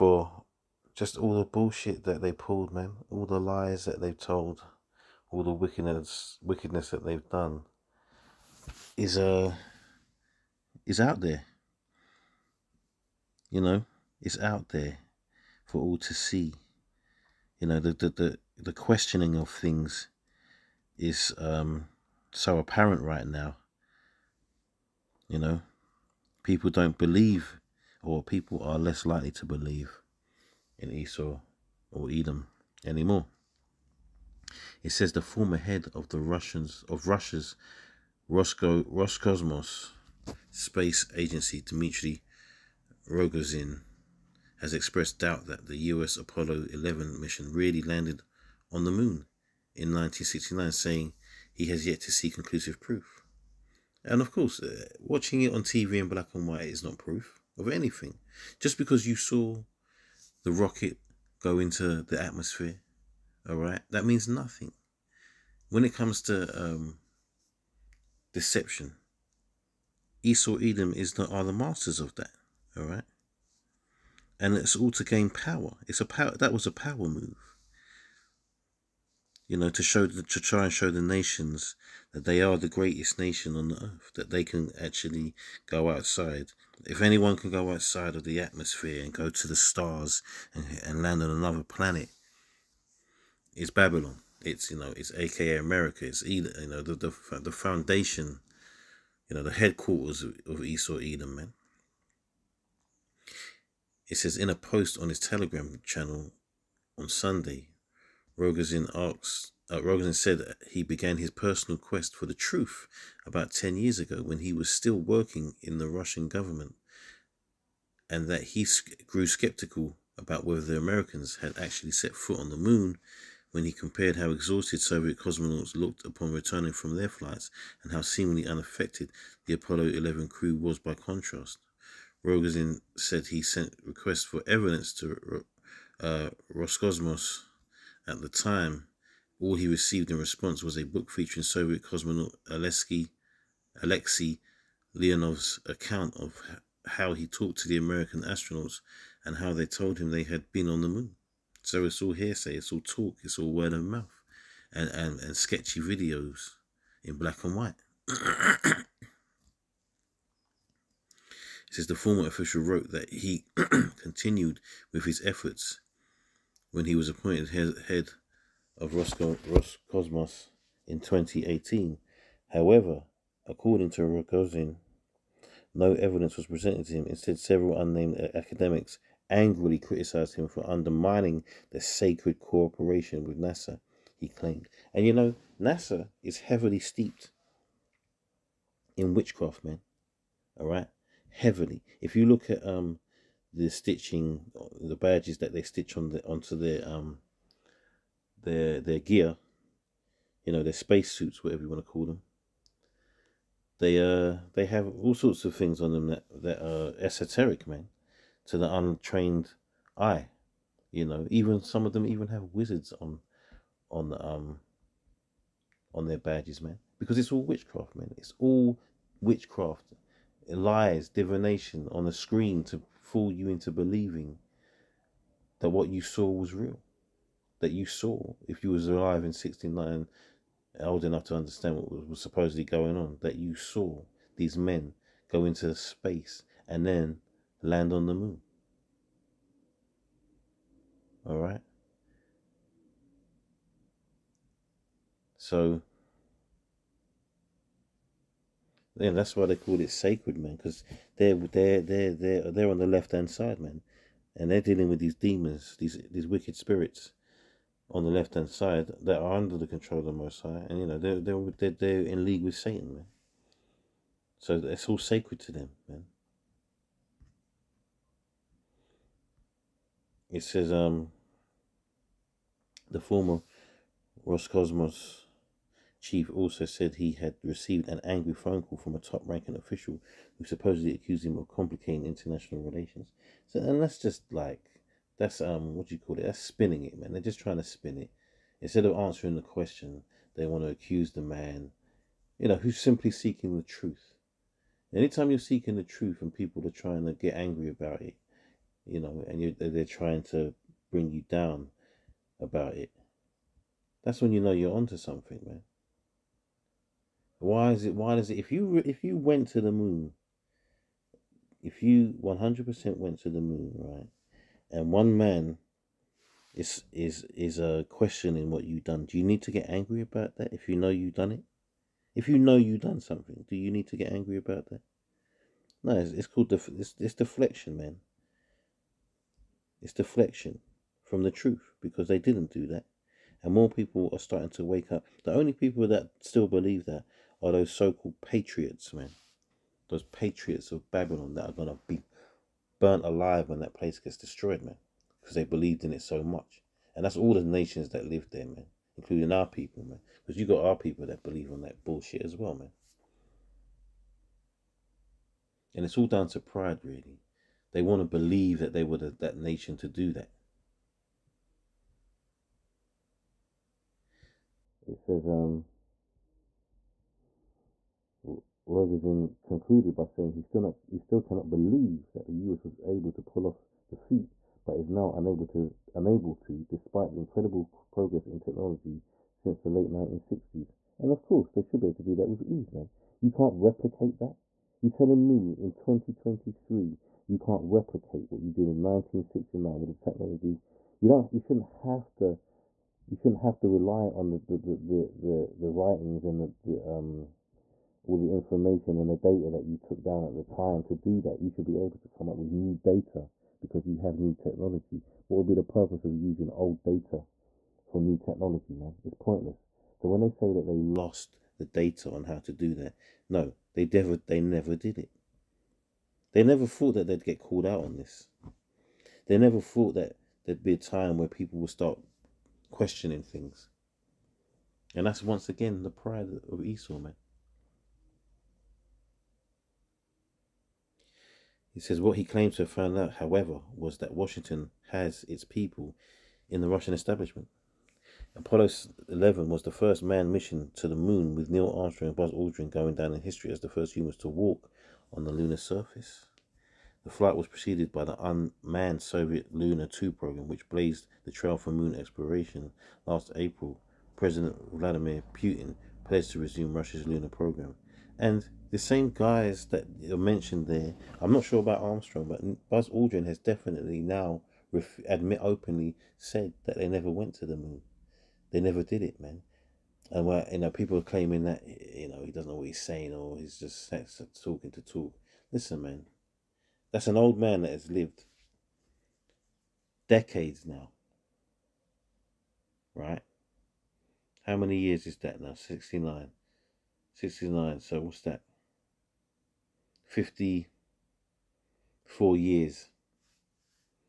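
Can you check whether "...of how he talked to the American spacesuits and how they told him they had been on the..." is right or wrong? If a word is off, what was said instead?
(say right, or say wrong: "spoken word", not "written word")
wrong: "astronauts", not "spacesuits".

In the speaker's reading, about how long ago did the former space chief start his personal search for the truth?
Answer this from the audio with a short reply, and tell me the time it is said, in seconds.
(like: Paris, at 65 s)
10 years, at 113 s.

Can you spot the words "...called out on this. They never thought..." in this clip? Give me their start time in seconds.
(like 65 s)
417 s.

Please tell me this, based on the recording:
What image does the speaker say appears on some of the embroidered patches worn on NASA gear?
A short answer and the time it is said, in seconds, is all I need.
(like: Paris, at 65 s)
Wizards, at 212 s.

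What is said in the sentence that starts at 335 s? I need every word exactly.
The only people that still believe that are those so-called patriots, man.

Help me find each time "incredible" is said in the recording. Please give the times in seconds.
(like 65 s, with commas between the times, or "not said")
377 s.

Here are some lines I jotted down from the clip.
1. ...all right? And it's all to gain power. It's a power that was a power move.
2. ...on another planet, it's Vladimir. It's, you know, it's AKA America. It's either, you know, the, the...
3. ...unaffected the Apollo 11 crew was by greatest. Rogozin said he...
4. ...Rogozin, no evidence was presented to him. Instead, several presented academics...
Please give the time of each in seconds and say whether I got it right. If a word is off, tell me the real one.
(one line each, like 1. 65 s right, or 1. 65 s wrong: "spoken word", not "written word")
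1. 72 s right
2. 91 s wrong: "Babylon", not "Vladimir"
3. 128 s wrong: "contrast", not "greatest"
4. 174 s wrong: "unnamed", not "presented".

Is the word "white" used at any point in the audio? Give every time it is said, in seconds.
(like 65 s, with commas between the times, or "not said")
56 s, 157 s.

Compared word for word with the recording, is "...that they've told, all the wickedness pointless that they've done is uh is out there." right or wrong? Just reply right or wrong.
wrong.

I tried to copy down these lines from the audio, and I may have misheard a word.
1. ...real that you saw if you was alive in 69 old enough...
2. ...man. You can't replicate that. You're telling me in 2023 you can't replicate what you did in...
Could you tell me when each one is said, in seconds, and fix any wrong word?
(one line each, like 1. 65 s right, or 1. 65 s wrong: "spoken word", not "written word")
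1. 226 s right
2. 382 s right.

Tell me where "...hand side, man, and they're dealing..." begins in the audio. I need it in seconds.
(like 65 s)
253 s.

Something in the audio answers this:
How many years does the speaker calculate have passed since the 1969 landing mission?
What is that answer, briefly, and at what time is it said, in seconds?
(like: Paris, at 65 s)
54, at 490 s.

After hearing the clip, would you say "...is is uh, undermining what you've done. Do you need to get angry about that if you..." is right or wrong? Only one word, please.
wrong.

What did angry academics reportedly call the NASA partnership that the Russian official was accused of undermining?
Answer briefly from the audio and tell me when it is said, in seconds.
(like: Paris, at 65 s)
sacred cooperation, at 181 s.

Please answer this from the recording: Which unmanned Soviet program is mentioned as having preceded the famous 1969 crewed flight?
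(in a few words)
Luna 2.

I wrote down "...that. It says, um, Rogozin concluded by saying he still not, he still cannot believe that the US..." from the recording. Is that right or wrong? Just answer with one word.
right.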